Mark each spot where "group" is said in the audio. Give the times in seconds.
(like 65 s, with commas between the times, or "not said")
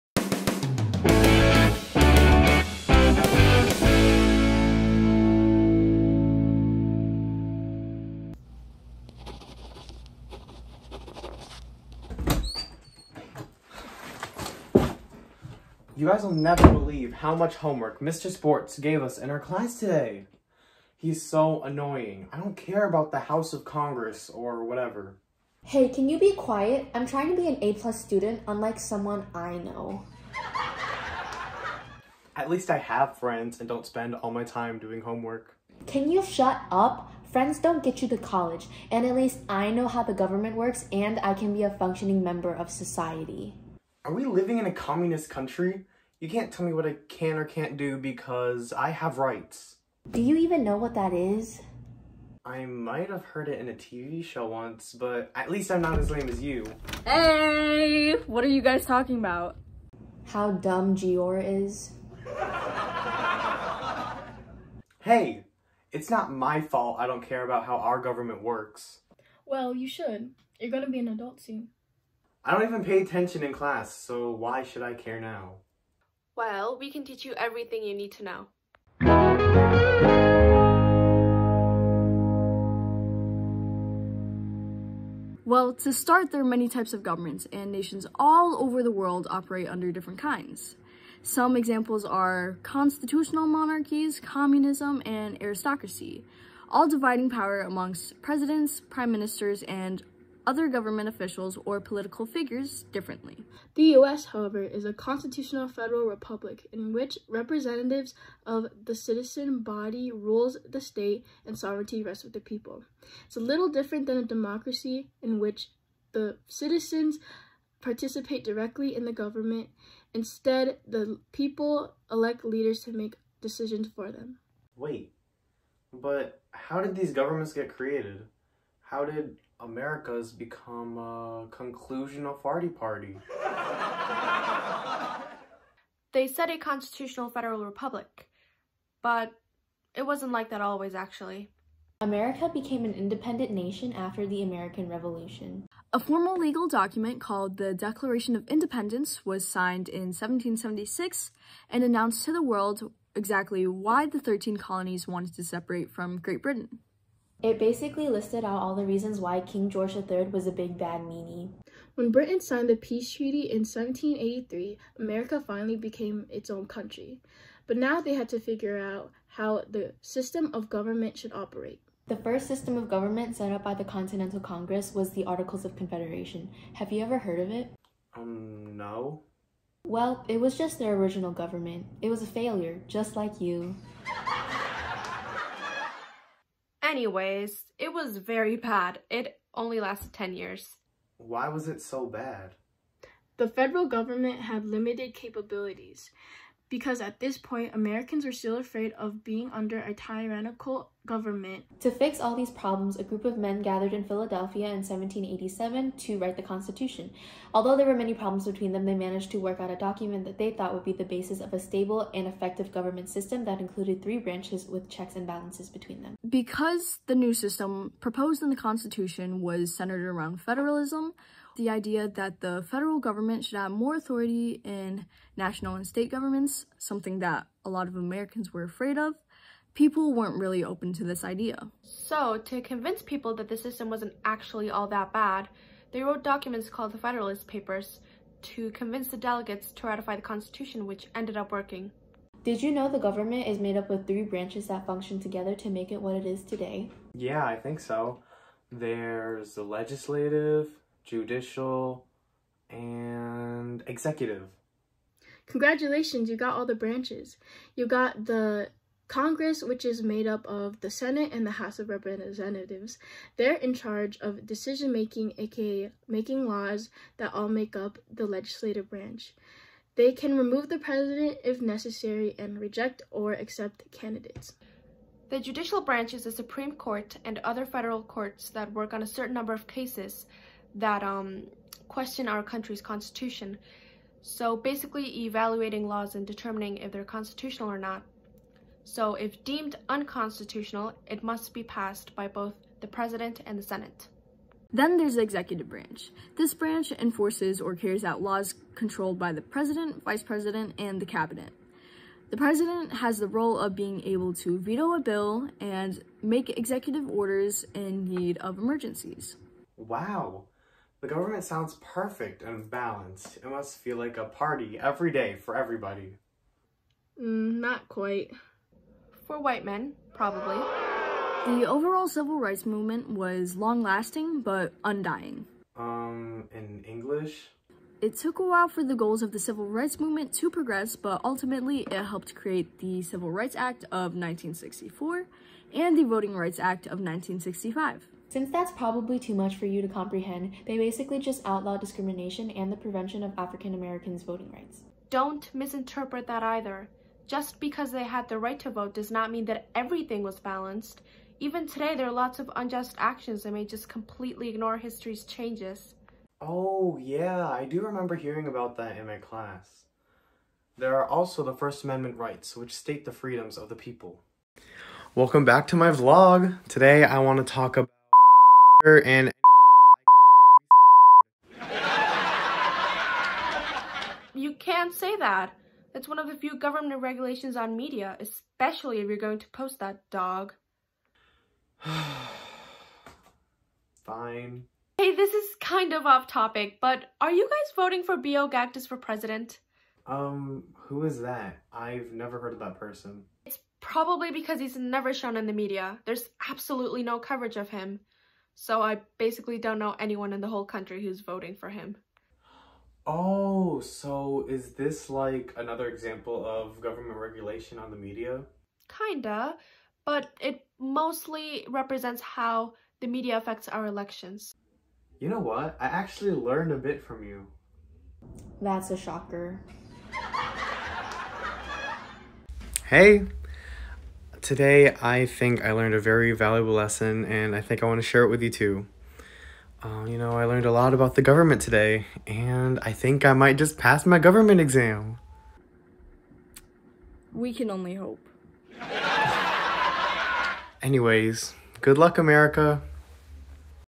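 203 s.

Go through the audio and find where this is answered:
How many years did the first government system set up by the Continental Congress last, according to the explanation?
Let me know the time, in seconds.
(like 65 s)
190 s.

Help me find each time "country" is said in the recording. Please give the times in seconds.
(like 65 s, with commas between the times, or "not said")
45 s, 166 s, 282 s, 400 s.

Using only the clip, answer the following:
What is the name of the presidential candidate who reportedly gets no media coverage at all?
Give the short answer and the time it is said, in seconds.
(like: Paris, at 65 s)
B.O. Gactus, at 388 s.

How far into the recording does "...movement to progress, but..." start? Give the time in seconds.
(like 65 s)
329 s.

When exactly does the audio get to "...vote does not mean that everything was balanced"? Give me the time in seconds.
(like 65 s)
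348 s.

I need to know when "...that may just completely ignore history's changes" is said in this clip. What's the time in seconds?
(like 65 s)
353 s.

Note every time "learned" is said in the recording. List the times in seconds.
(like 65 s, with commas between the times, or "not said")
416 s, 425 s, 430 s.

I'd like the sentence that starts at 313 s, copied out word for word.
It must feel like a party every day for everybody.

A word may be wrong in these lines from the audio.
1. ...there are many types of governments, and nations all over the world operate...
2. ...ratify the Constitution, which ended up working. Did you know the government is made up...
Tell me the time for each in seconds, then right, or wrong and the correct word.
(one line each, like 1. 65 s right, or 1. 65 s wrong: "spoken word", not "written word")
1. 86 s right
2. 239 s right.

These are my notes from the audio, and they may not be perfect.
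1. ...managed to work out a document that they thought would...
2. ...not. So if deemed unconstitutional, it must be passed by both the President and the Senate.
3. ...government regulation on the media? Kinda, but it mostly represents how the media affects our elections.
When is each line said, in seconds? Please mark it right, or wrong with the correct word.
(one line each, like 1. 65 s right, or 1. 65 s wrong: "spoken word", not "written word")
1. 208 s right
2. 287 s right
3. 406 s right.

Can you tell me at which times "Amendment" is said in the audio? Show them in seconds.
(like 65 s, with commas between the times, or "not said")
361 s.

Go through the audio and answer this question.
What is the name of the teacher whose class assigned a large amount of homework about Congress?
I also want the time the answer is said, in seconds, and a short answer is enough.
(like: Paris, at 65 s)
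Mr. Sports, at 18 s.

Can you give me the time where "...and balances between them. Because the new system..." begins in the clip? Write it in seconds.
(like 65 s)
215 s.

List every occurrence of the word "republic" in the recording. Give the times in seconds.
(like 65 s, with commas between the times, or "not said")
106 s, 137 s.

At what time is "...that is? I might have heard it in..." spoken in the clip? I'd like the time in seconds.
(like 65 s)
50 s.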